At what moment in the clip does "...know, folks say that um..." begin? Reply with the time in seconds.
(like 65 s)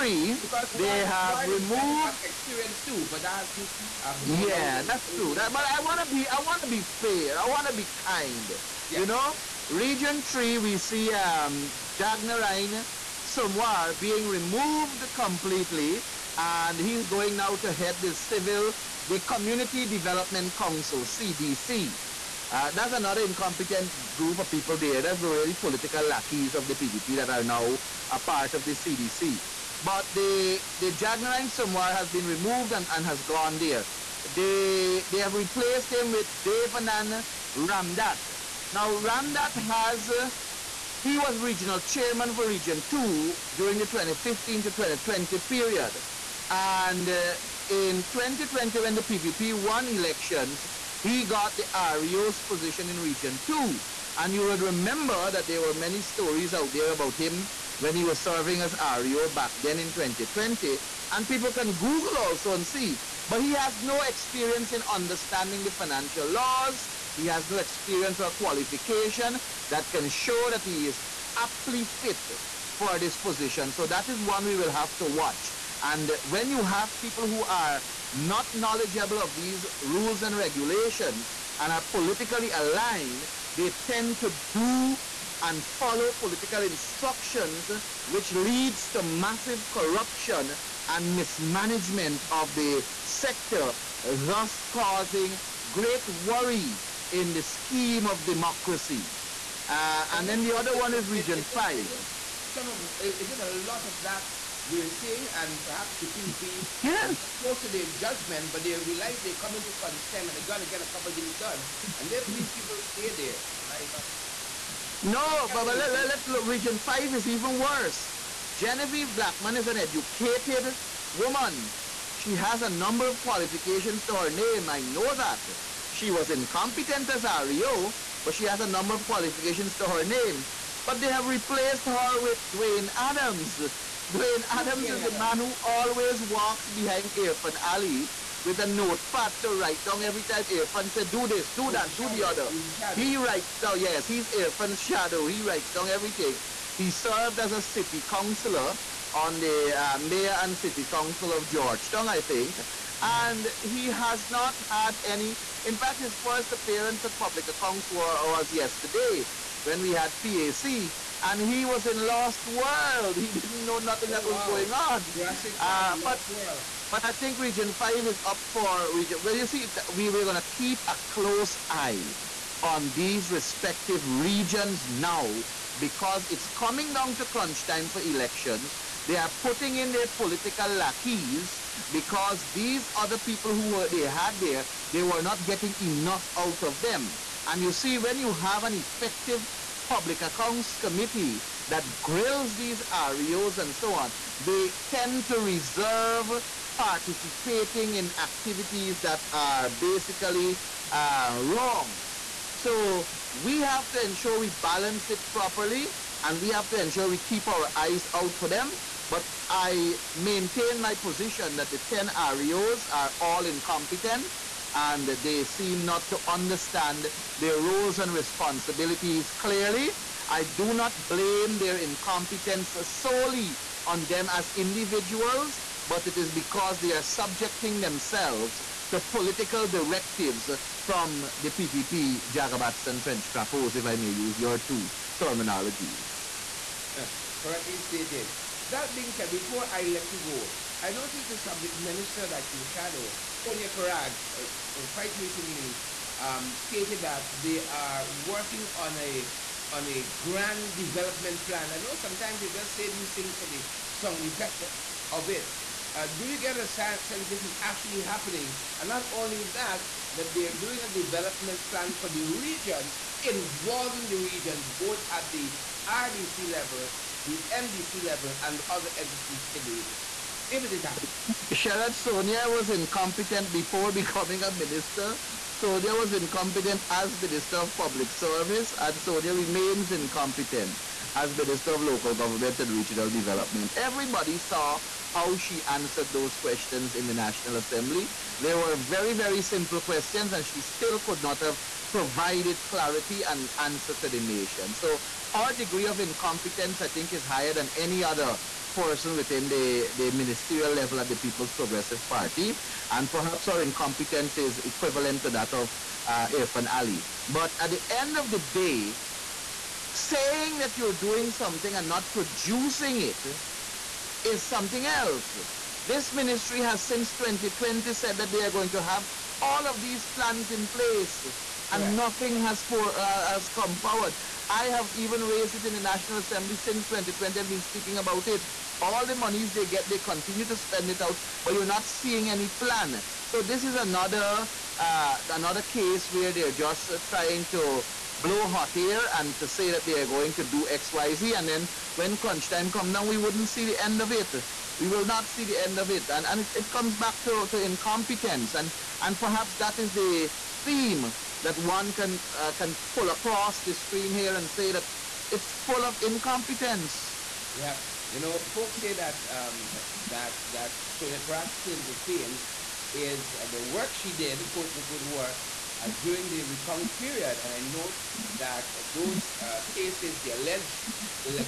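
358 s.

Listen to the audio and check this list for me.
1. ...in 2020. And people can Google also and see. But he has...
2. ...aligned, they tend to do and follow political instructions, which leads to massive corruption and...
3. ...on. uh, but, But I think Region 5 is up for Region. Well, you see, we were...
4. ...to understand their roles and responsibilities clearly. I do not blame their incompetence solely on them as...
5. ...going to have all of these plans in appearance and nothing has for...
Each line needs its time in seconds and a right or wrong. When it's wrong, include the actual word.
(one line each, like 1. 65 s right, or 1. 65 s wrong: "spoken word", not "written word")
1. 59 s right
2. 82 s right
3. 164 s right
4. 216 s right
5. 318 s wrong: "place", not "appearance".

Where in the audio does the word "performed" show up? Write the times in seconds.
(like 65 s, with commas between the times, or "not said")
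not said.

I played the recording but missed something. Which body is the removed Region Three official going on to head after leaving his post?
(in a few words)
Community Development Council.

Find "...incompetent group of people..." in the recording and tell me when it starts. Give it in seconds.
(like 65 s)
23 s.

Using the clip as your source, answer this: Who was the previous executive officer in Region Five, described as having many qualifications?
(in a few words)
Genevieve Blackman.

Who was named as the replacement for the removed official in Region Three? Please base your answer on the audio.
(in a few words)
Devanan Ramdat.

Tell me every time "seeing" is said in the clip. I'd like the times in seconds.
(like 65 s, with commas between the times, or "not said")
104 s, 331 s.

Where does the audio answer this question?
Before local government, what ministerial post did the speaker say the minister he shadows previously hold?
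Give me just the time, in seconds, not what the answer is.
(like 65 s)
277 s.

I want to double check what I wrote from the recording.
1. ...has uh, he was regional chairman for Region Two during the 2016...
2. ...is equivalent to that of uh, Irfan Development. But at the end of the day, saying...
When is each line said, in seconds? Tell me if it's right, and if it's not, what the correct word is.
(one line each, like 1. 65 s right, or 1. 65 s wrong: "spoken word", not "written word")
1. 39 s wrong: "2015", not "2016"
2. 304 s wrong: "Ali", not "Development".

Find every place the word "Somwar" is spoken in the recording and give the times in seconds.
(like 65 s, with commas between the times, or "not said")
13 s, 31 s.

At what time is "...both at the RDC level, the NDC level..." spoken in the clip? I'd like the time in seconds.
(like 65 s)
264 s.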